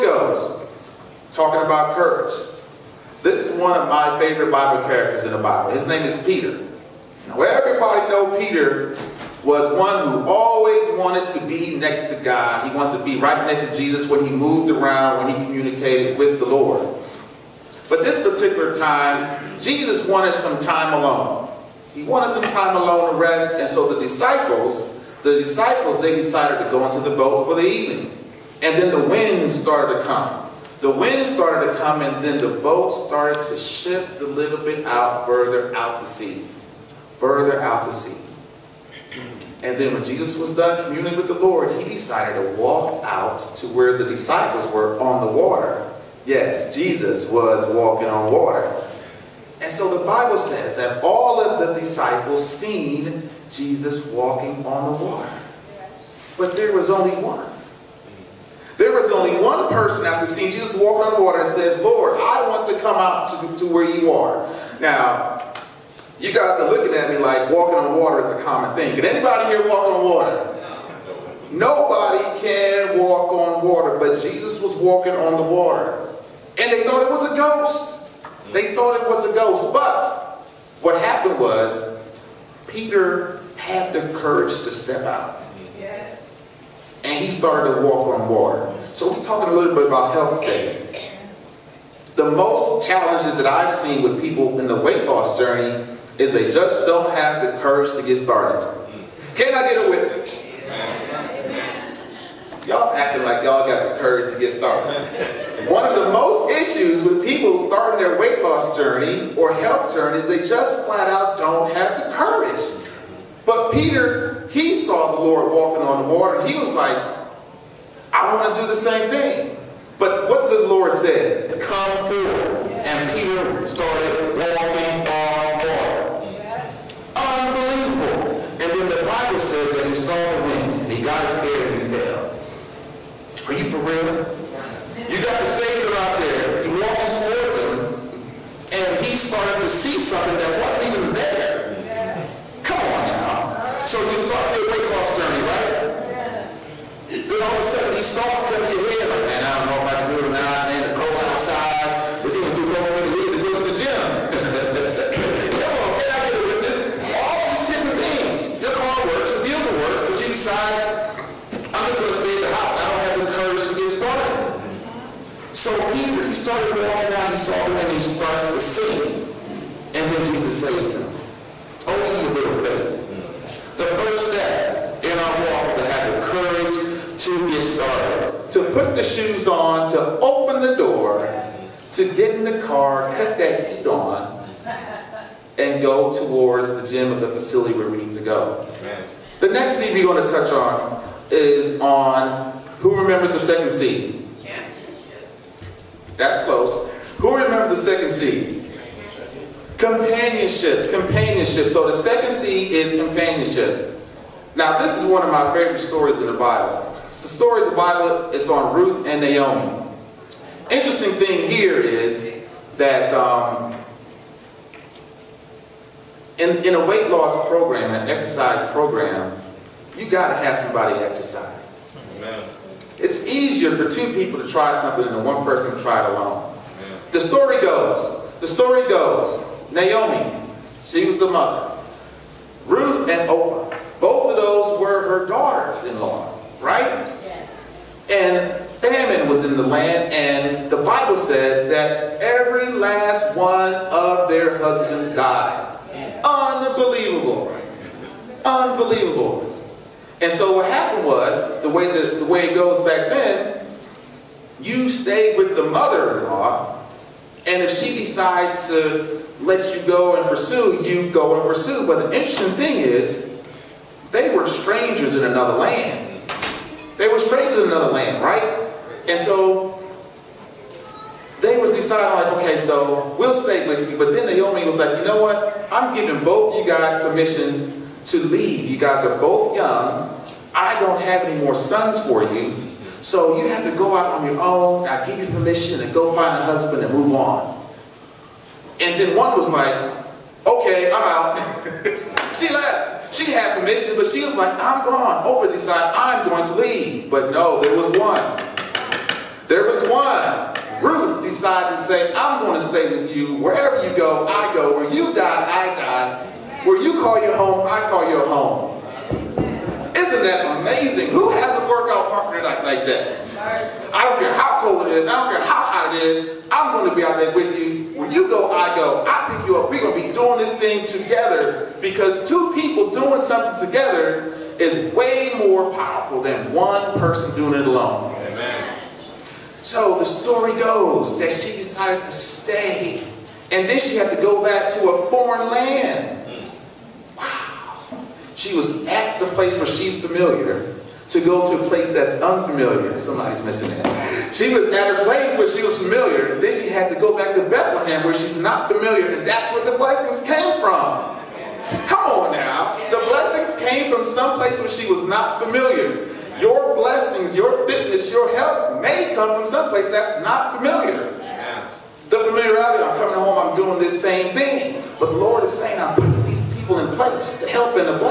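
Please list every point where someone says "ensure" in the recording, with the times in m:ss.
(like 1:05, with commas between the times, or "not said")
not said.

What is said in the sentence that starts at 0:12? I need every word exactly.
He wants to be right next to Jesus when he moved around, when he communicated with the Lord.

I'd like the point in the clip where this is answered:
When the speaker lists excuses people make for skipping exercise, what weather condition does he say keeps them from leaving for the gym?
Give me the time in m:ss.
2:30.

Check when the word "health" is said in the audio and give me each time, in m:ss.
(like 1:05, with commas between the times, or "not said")
1:30, 1:49.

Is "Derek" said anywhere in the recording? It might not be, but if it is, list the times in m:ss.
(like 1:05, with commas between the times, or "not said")
not said.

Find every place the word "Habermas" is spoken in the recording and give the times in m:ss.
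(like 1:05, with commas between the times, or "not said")
not said.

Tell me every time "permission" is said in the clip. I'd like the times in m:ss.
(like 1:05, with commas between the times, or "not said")
4:37, 4:45, 4:53.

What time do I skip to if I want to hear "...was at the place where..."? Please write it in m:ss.
5:38.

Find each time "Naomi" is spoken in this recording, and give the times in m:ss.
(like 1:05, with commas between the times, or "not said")
3:29, 3:49.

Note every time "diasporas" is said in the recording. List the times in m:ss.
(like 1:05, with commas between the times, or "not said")
not said.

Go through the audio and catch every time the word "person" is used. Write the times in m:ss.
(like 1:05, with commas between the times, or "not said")
0:59, 3:45, 5:26.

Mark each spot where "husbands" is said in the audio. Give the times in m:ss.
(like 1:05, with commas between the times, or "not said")
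4:04, 4:46.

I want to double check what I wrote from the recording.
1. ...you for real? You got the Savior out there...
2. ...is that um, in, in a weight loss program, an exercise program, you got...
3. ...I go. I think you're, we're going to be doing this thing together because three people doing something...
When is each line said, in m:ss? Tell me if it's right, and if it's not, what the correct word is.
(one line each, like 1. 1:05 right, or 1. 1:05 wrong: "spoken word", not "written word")
1. 2:13 right
2. 3:31 right
3. 5:18 wrong: "two", not "three".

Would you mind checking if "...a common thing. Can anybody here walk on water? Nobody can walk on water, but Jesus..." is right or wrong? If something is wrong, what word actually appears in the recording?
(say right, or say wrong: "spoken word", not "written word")
right.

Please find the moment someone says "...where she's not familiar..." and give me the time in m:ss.
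5:48.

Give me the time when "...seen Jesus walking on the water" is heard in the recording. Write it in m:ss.
0:52.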